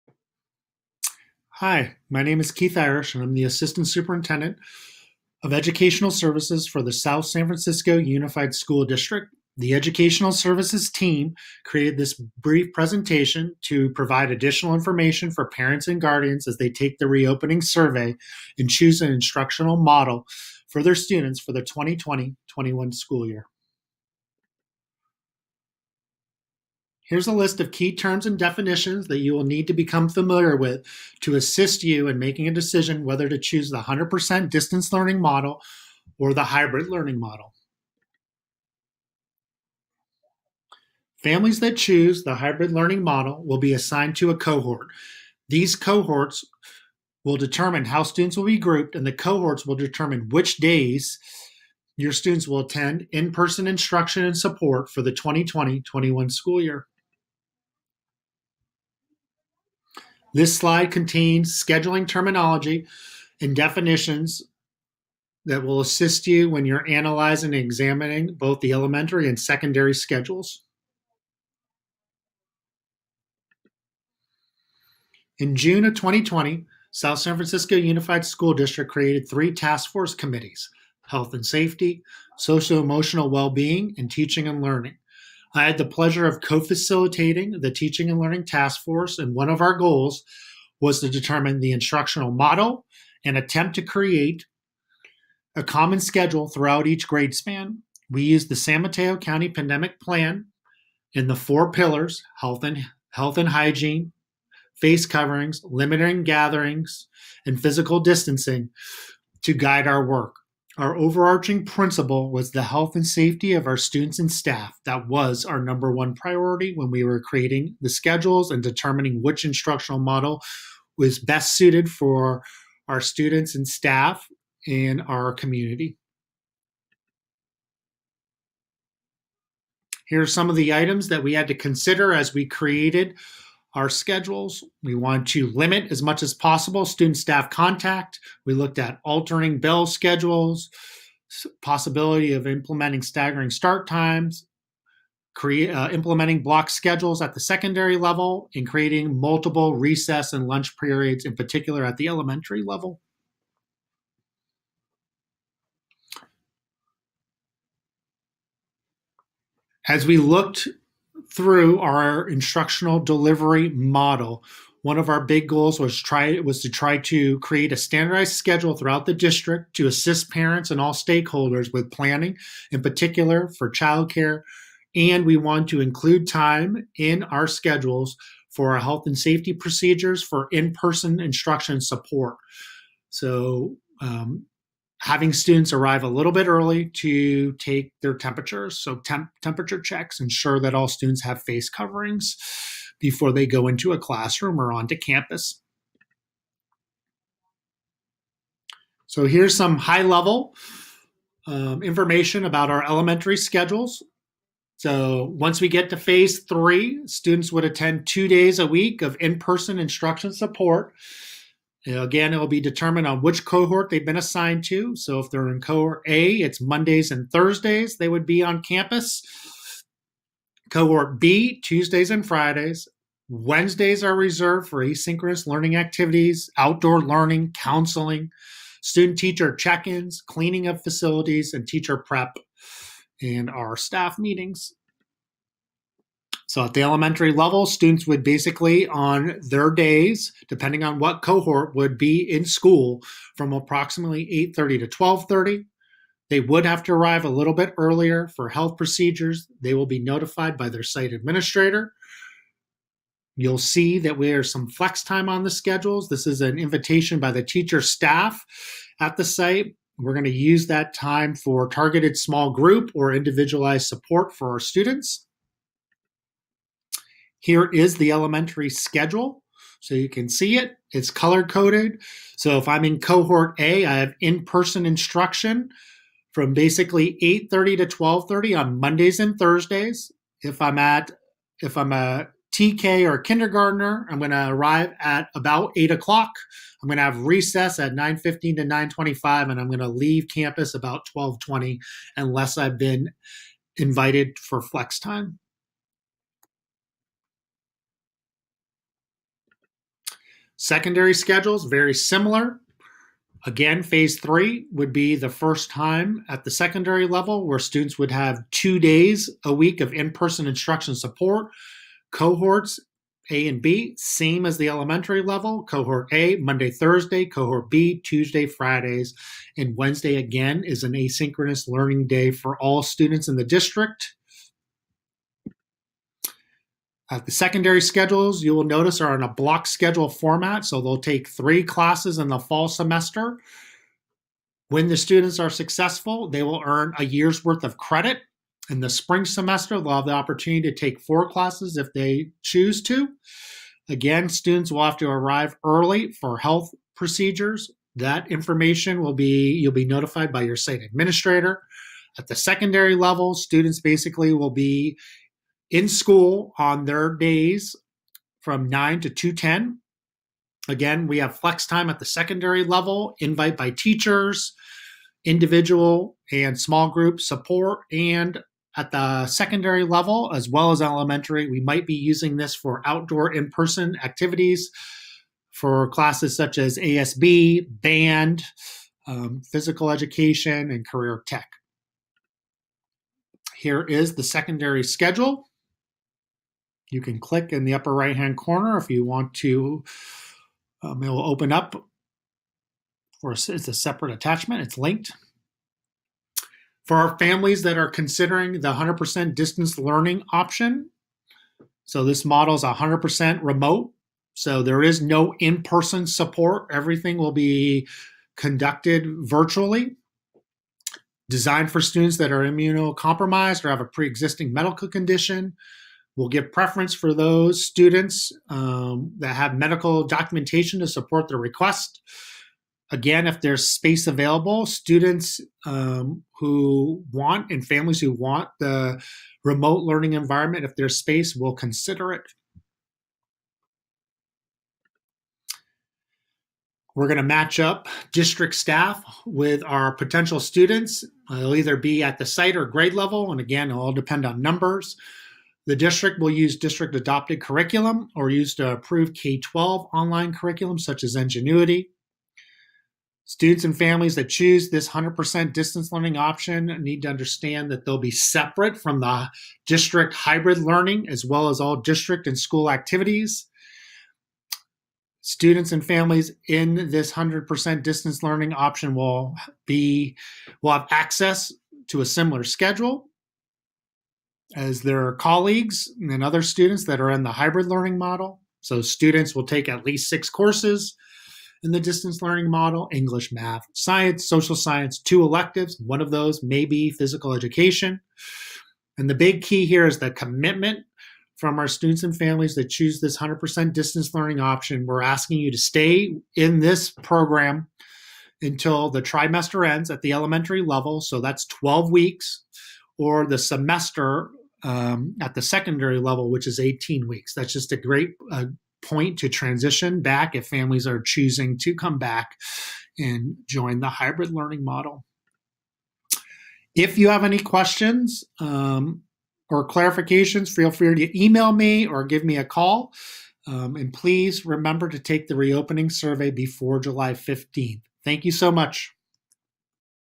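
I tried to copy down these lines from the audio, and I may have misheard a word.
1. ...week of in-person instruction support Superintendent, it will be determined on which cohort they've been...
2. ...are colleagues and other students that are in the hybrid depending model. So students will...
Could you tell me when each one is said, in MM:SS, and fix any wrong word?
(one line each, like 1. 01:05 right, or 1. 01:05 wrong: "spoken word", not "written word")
1. 03:28 wrong: "Again", not "Superintendent"
2. 07:55 wrong: "learning", not "depending".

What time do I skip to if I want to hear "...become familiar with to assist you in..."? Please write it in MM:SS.
00:29.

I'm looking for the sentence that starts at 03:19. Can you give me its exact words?
So here's some high level um, information about our elementary schedules.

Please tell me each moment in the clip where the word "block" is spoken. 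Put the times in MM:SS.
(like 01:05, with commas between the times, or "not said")
02:26, 05:29.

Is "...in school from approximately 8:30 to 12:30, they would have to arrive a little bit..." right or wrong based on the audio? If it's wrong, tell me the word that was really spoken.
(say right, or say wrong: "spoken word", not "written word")
right.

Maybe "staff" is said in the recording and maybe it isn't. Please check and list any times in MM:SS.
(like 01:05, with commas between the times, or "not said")
01:54, 02:03, 02:17, 03:53, 04:17, 07:18.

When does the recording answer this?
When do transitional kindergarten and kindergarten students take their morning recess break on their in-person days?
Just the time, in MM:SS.
04:47.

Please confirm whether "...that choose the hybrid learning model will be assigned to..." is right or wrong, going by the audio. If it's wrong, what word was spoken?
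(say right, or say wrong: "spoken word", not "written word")
right.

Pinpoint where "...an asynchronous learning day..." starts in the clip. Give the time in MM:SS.
05:20.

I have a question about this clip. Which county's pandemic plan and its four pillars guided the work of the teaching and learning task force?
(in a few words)
San Mateo County.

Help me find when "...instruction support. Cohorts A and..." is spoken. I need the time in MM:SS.
05:10.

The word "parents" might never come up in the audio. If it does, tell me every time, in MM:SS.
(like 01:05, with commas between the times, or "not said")
00:15, 02:50.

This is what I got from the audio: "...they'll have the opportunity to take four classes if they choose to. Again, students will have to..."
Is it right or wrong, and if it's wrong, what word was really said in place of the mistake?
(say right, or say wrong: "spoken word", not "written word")
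right.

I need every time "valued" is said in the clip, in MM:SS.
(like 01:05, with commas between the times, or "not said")
not said.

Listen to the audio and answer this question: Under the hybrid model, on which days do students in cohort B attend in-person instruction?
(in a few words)
Tuesdays and Fridays.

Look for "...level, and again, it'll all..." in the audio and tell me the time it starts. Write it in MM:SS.
07:22.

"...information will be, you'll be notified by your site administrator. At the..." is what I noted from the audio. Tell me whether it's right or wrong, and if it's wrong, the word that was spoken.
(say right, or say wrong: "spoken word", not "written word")
right.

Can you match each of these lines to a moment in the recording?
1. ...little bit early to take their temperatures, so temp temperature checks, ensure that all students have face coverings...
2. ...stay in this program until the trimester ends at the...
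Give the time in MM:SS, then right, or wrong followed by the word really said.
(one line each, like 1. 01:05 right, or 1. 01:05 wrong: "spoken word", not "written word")
1. 03:06 right
2. 08:15 right.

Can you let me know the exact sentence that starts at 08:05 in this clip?
One of those may be physical education.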